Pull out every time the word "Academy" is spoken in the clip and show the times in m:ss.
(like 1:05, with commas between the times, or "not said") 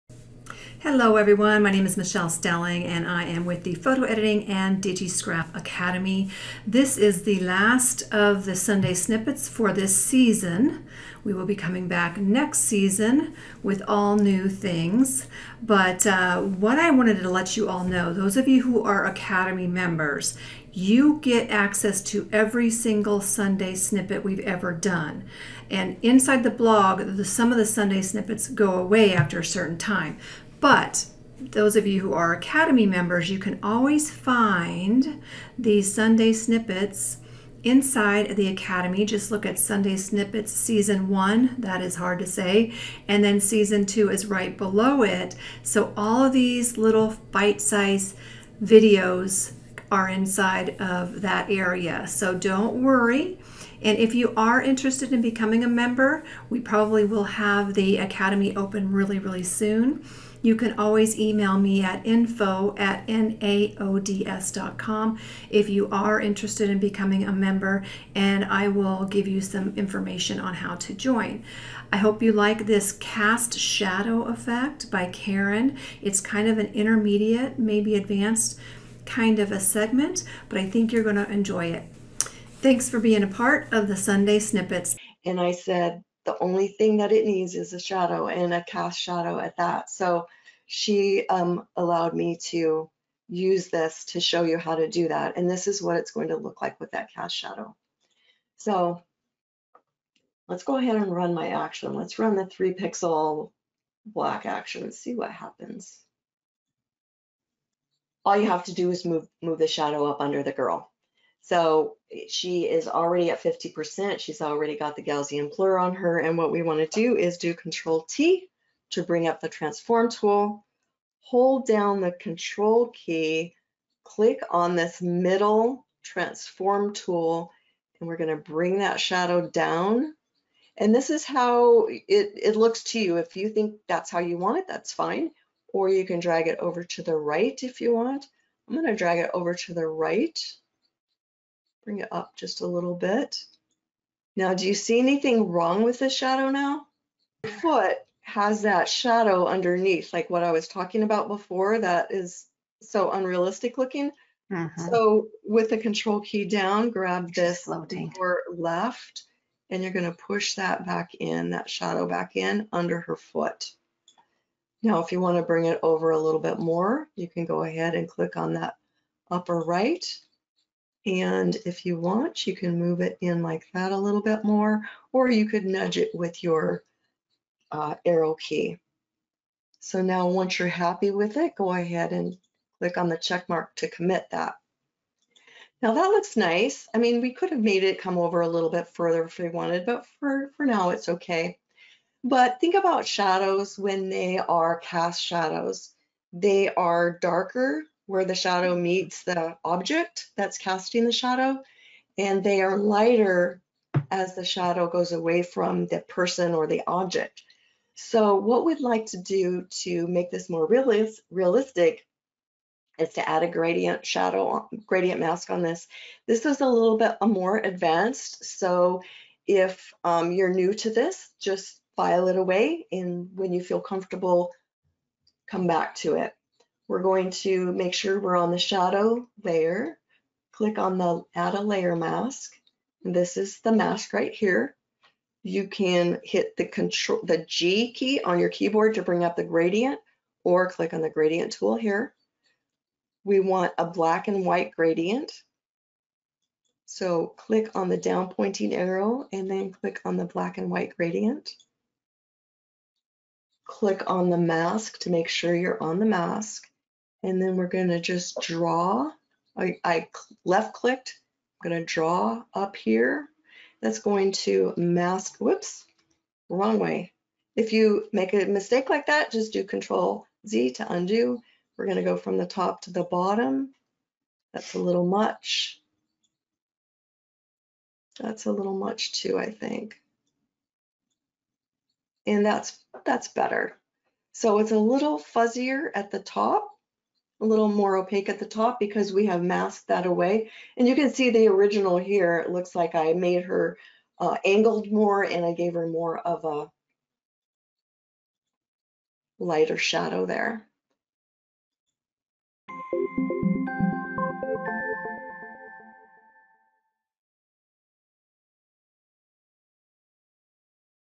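0:05, 0:19, 0:32, 0:38, 0:57.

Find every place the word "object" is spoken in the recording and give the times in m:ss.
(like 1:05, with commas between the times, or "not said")
3:19, 3:26.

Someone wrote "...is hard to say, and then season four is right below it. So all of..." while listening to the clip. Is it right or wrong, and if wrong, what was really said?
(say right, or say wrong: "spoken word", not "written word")
wrong: "two", not "four".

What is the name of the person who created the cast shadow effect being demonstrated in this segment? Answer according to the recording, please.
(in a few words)
Karen.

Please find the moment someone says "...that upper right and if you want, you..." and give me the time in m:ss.
2:48.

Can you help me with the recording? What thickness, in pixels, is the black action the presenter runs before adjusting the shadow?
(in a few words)
3.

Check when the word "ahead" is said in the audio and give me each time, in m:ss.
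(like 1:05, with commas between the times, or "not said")
1:40, 2:47, 3:01.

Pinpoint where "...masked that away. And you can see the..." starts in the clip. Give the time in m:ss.
4:49.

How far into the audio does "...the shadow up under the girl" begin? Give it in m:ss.
1:49.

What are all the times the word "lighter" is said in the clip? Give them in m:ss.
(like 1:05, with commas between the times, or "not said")
3:22, 4:59.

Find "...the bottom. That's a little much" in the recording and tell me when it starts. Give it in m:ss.
4:32.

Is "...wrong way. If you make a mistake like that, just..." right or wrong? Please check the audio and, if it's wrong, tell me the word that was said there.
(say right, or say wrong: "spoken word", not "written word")
right.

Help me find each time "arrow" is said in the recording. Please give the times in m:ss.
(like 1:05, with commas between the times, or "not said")
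2:58, 4:08.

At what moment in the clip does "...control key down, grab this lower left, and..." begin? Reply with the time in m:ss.
2:35.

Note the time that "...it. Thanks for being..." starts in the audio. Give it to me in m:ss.
1:21.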